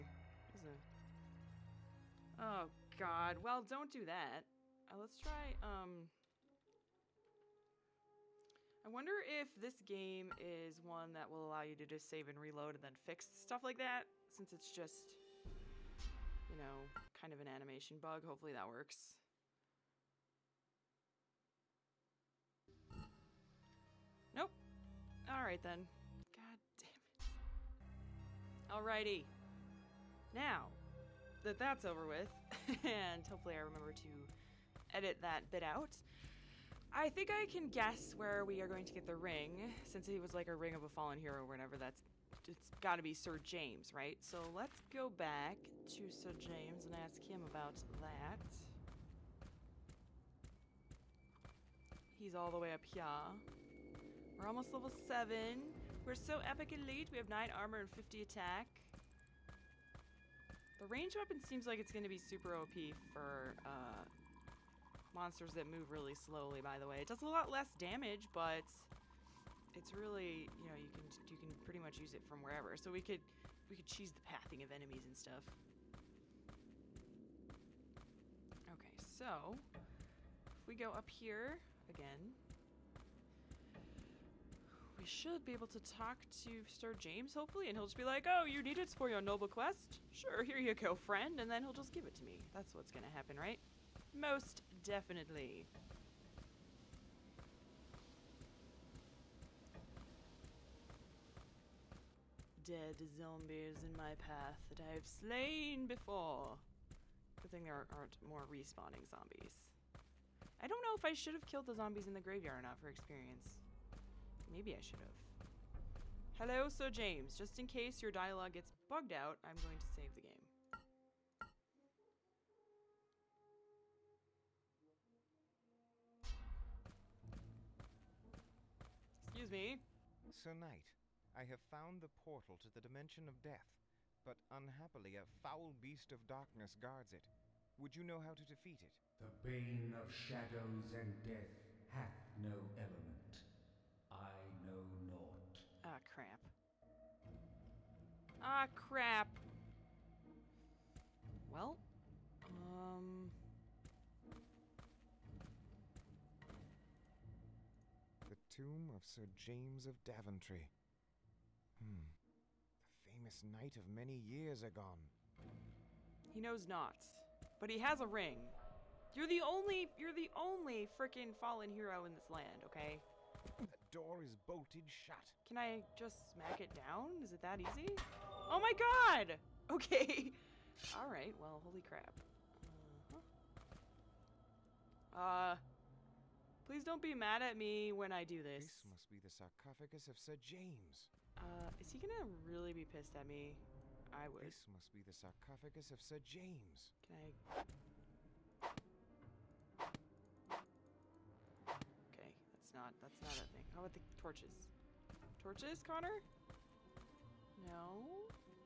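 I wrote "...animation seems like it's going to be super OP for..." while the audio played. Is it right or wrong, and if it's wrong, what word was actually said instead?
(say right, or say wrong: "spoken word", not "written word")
wrong: "weapon", not "animation".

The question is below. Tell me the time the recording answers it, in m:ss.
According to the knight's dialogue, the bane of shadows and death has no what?
2:22.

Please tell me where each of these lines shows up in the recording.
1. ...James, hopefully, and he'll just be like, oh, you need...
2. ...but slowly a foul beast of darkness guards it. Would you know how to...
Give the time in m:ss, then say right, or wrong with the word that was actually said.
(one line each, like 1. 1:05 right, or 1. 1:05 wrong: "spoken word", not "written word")
1. 1:26 right
2. 2:14 wrong: "unhappily", not "slowly".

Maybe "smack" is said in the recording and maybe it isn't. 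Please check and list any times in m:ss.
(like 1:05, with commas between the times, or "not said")
2:56.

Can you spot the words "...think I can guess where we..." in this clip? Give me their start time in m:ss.
0:37.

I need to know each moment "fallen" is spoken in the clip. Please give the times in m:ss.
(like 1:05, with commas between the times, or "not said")
0:40, 2:51.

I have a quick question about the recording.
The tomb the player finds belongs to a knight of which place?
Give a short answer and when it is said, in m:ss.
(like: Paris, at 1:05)
Daventry, at 2:40.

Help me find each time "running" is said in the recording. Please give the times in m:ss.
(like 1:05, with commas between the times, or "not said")
not said.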